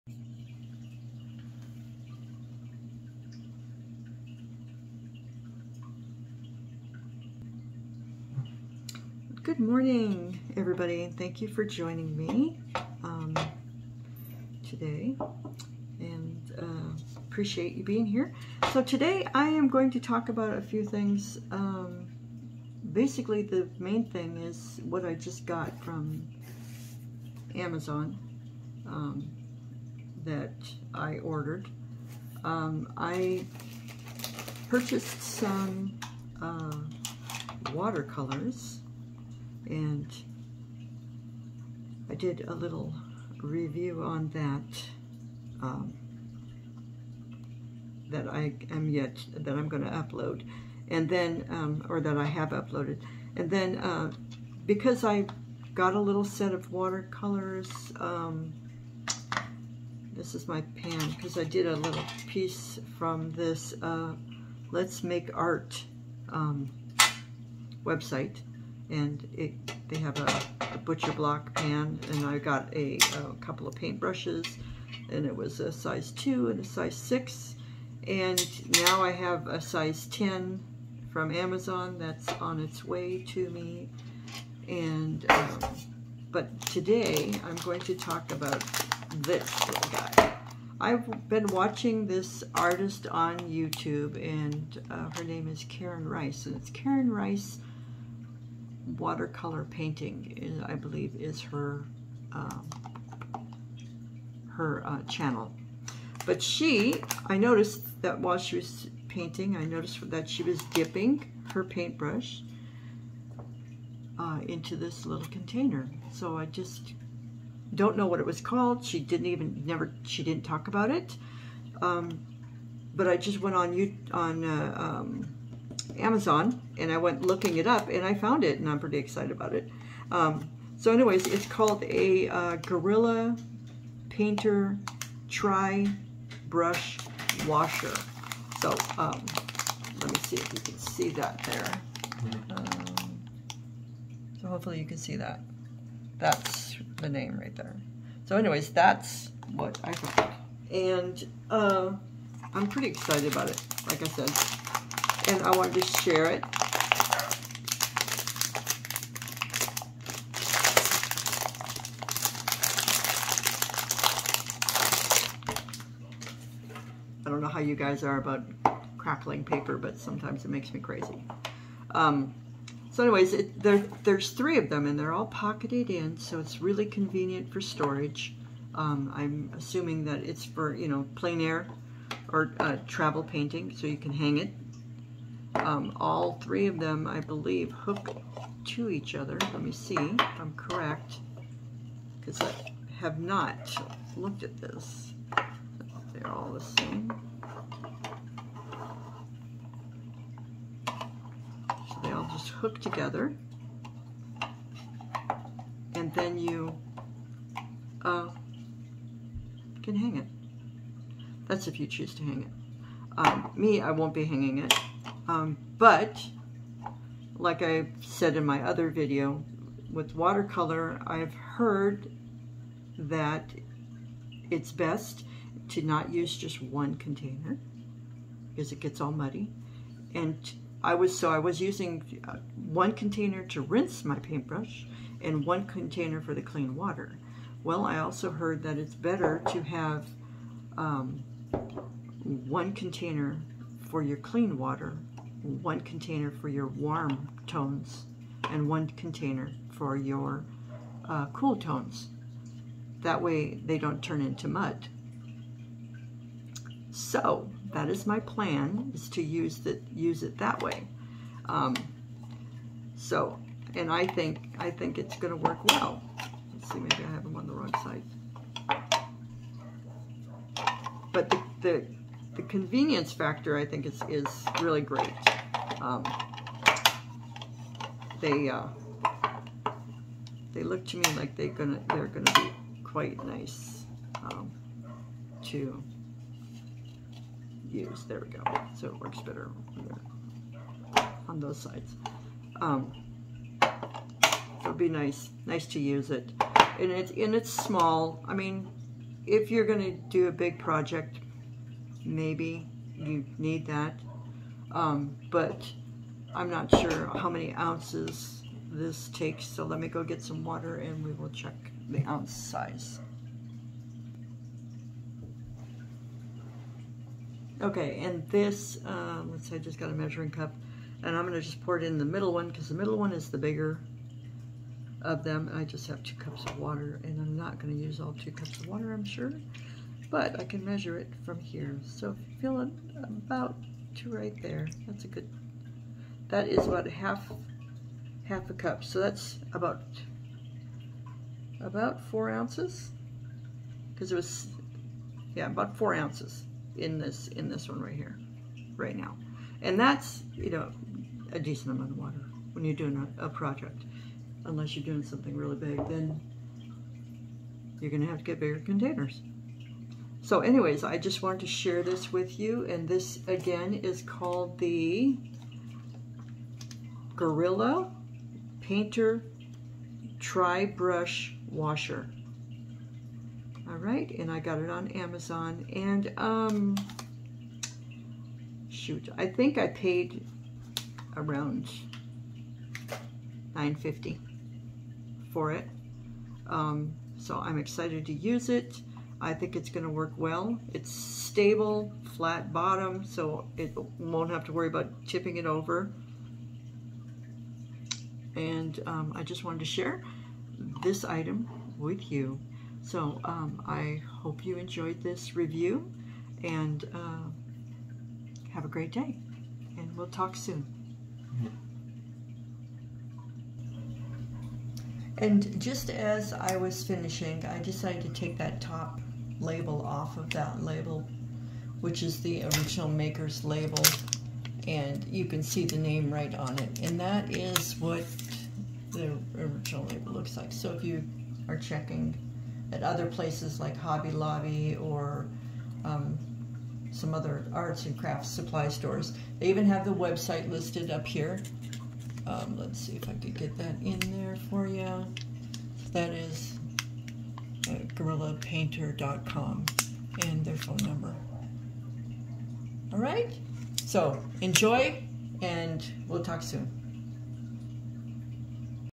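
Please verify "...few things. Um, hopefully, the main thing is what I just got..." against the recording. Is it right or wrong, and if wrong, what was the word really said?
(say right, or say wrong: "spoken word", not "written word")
wrong: "basically", not "hopefully".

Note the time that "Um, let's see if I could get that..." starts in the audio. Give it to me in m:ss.
7:22.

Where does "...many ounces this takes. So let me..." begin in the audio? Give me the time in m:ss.
5:07.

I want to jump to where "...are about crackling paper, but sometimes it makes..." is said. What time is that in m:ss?
2:48.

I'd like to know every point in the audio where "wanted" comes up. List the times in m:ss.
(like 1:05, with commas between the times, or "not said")
2:35, 6:01, 6:39.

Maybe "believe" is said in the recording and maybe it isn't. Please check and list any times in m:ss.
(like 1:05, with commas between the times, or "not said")
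1:40, 3:07.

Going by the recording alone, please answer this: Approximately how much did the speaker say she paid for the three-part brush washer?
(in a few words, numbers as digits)
$9.50.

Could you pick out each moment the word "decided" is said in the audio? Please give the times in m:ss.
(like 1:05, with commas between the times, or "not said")
6:57.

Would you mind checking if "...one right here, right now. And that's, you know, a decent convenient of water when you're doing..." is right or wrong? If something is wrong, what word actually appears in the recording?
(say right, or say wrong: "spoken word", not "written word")
wrong: "amount", not "convenient".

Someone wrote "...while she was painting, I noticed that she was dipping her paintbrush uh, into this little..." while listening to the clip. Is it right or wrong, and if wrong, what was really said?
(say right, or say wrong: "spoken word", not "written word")
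right.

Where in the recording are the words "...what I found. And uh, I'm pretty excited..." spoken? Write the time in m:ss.
2:29.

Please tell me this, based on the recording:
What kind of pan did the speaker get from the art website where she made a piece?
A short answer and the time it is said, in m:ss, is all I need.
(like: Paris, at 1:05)
butcher block pan, at 1:10.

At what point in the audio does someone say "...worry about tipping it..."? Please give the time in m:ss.
6:34.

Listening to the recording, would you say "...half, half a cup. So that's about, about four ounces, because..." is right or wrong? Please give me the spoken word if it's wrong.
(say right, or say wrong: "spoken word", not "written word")
right.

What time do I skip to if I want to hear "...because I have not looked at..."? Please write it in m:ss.
3:12.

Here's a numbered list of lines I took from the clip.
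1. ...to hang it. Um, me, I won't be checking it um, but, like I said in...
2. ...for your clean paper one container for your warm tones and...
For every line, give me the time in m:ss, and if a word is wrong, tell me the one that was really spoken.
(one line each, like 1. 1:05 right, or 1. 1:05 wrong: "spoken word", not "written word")
1. 3:32 wrong: "hanging", not "checking"
2. 4:03 wrong: "water", not "paper".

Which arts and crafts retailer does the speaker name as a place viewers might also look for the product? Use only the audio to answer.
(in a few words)
Hobby Lobby.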